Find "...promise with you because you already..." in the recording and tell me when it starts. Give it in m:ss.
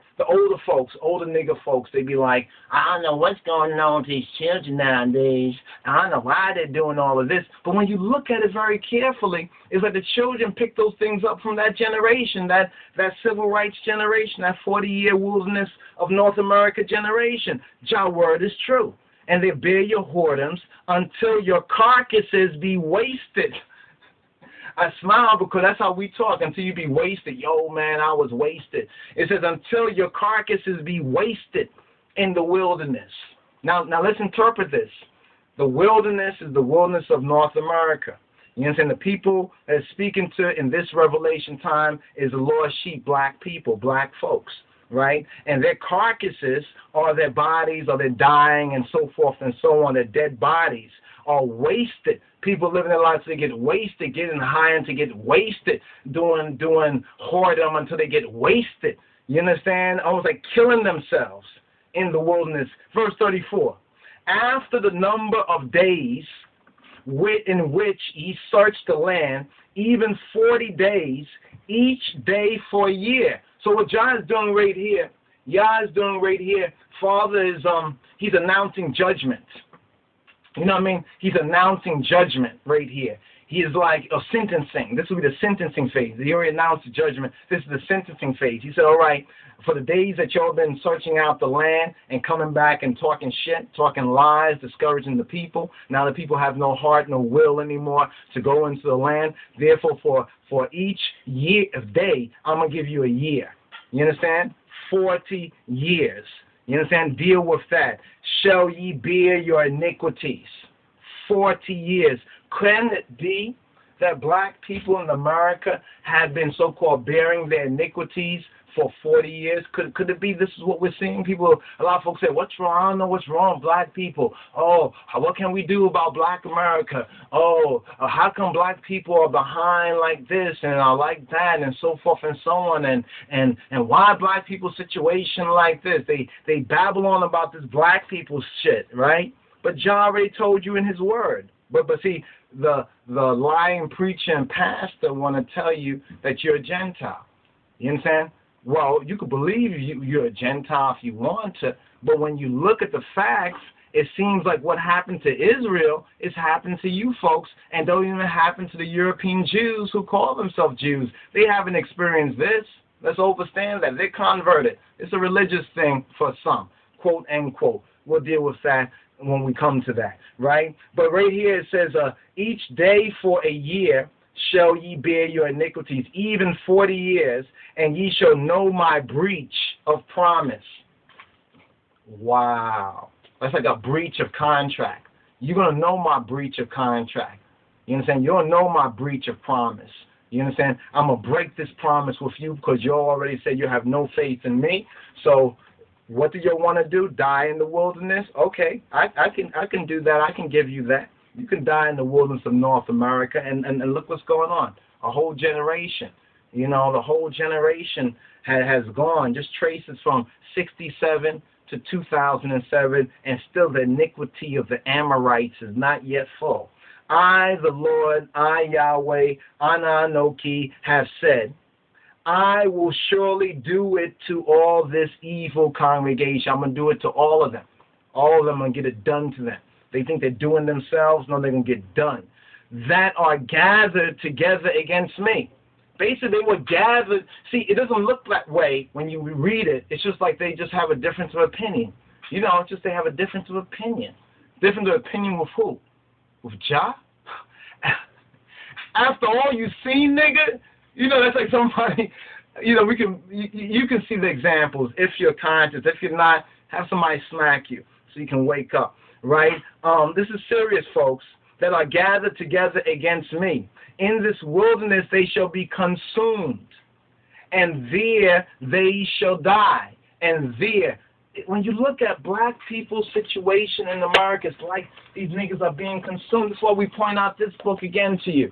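3:11.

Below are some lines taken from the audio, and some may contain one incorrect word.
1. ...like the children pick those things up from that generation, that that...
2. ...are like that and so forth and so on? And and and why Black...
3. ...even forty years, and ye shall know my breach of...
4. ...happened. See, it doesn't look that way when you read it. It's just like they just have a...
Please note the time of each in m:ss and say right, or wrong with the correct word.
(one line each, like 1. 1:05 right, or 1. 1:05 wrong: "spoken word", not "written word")
1. 0:09 right
2. 2:10 right
3. 2:56 right
4. 3:56 wrong: "gathered", not "happened".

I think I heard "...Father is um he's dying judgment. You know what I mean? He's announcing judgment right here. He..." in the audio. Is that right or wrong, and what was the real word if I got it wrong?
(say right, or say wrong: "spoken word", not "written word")
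wrong: "announcing", not "dying".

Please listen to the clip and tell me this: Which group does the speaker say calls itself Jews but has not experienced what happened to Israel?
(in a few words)
European Jews.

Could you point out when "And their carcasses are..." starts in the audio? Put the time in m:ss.
0:45.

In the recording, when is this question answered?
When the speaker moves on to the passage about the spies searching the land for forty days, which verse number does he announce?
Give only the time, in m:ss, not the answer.
1:02.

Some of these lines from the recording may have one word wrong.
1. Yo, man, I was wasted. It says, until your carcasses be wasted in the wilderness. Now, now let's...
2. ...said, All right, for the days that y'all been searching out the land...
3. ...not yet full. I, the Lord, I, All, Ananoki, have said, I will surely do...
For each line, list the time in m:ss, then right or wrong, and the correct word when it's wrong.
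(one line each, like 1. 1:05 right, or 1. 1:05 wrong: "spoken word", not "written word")
1. 0:27 right
2. 1:28 right
3. 3:35 wrong: "Yahweh", not "All".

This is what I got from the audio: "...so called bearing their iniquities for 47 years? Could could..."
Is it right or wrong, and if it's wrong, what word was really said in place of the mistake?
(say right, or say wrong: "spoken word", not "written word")
wrong: "40", not "47".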